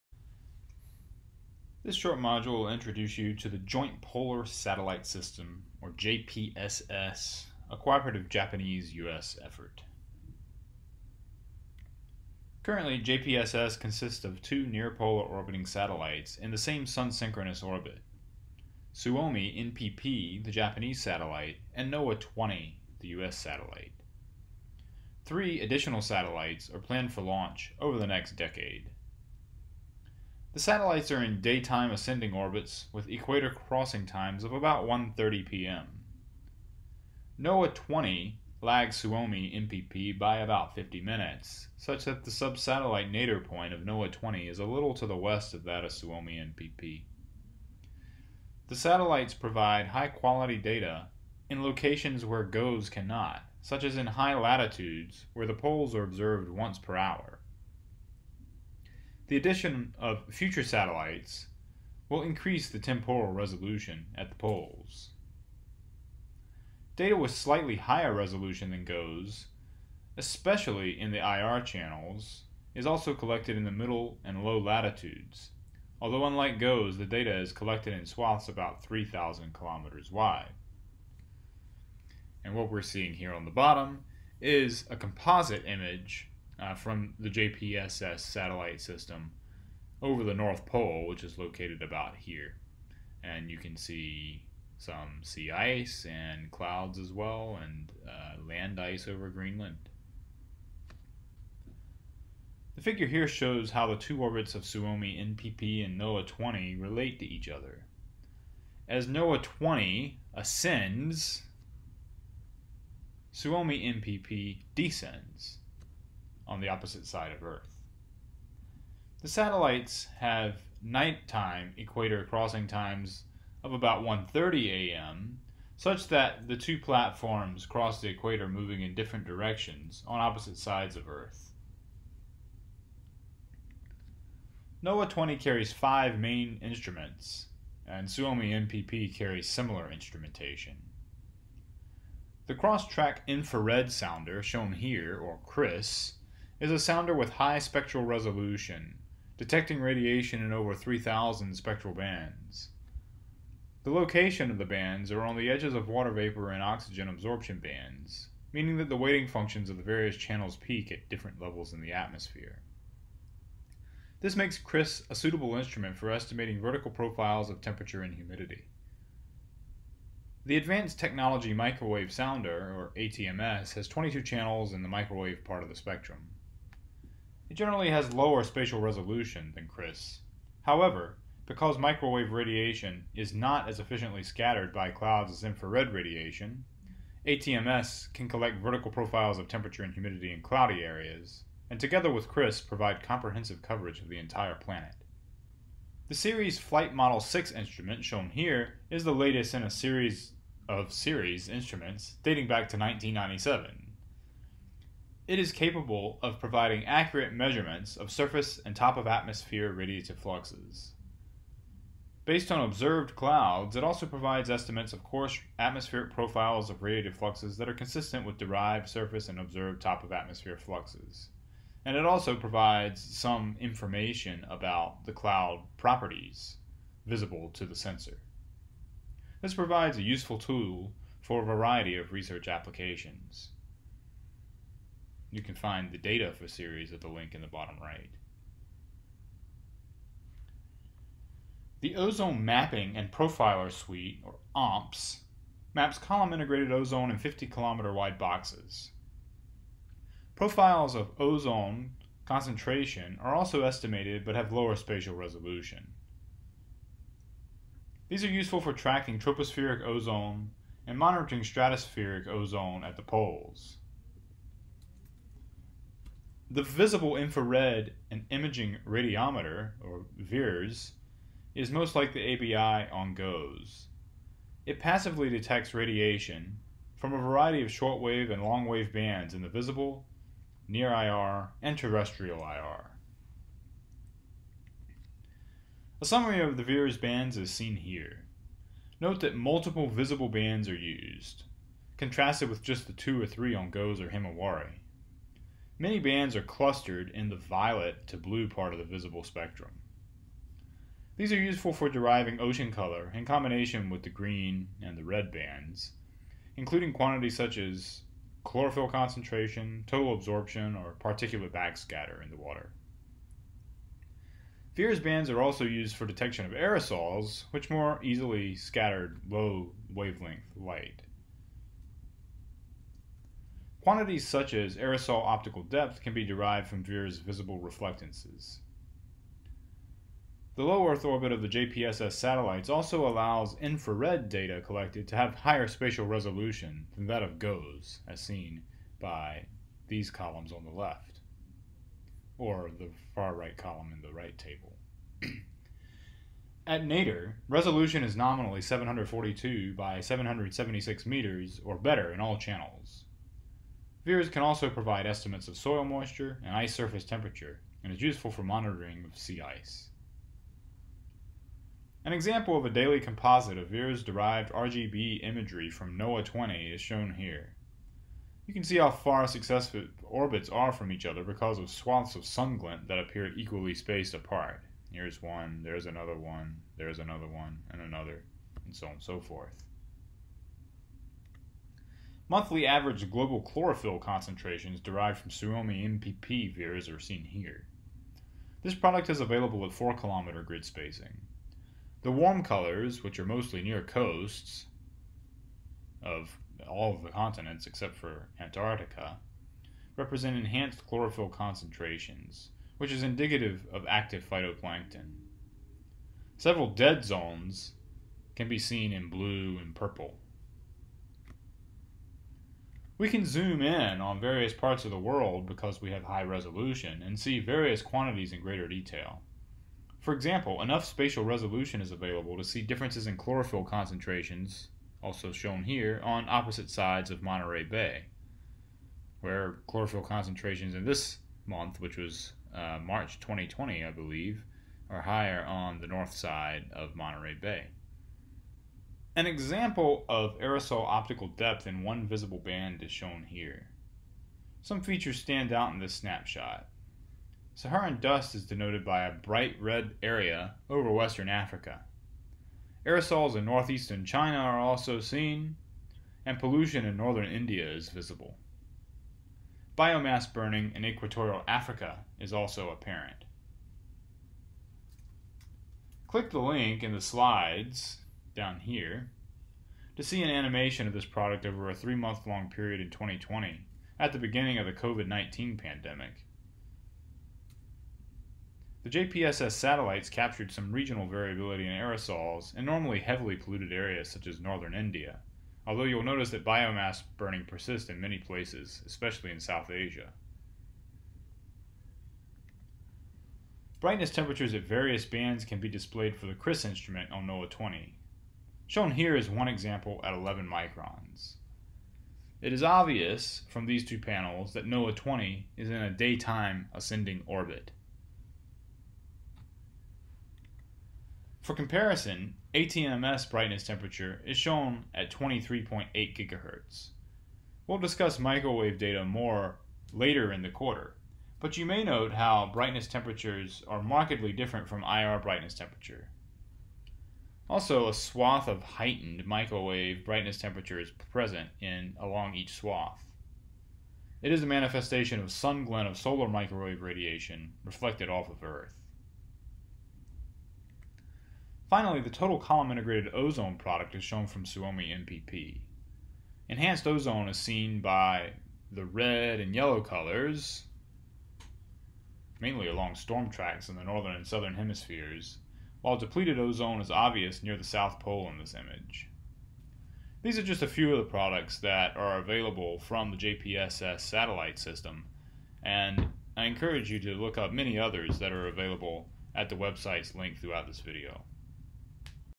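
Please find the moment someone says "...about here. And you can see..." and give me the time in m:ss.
1:31.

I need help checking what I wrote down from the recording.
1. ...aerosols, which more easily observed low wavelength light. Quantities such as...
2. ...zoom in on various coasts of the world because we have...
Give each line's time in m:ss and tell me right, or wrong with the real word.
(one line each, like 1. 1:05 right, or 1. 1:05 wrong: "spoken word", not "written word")
1. 5:16 wrong: "scattered", not "observed"
2. 6:53 wrong: "parts", not "coasts".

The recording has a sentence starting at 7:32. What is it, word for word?
Aerosols in northeastern China are also seen, and pollution in northern India is visible.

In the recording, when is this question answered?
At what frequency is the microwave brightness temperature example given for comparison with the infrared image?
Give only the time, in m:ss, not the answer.
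8:35.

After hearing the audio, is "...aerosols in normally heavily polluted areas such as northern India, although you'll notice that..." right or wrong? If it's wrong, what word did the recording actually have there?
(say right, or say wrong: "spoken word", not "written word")
right.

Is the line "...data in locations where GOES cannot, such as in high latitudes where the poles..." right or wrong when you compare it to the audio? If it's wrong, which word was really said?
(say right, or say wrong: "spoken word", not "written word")
right.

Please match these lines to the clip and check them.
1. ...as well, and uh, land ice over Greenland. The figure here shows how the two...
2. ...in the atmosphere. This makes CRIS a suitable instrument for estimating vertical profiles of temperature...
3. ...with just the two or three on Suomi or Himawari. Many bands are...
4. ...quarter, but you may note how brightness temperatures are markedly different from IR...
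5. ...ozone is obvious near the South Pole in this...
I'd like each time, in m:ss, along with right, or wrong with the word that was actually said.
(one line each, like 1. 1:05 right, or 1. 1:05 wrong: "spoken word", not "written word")
1. 1:36 right
2. 2:41 right
3. 4:52 wrong: "GOES", not "Suomi"
4. 8:40 right
5. 9:16 right.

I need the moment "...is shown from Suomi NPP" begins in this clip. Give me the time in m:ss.
9:03.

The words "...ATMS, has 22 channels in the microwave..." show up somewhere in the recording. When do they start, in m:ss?
2:52.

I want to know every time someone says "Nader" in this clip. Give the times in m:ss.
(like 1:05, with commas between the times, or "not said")
5:46.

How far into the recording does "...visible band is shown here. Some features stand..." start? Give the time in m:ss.
7:22.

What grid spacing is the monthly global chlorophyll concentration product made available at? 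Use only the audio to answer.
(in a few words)
4 kilometers.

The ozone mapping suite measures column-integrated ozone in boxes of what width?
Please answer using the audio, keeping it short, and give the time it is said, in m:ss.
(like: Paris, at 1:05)
50 kilometers, at 4:07.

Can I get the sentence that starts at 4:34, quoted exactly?
It passively detects radiation from a variety of shortwave and longwave bands in the visible, near IR, and terrestrial IR.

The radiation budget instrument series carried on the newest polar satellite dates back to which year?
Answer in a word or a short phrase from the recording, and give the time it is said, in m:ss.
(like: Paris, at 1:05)
1997, at 3:22.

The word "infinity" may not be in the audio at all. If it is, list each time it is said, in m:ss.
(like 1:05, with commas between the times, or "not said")
not said.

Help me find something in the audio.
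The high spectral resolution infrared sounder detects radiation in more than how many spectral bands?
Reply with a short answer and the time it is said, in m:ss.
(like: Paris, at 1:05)
3,000, at 2:30.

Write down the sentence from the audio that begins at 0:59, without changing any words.
The addition of future satellites will increase the temporal resolution at the poles.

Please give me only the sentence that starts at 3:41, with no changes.
And it also provides some information about the cloud properties visible to the sensor.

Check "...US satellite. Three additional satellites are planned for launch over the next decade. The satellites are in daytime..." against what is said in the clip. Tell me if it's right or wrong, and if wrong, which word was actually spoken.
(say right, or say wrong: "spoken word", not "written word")
right.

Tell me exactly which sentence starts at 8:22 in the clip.
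It is obvious from these two panels that NOAA 20 is in a daytime ascending orbit.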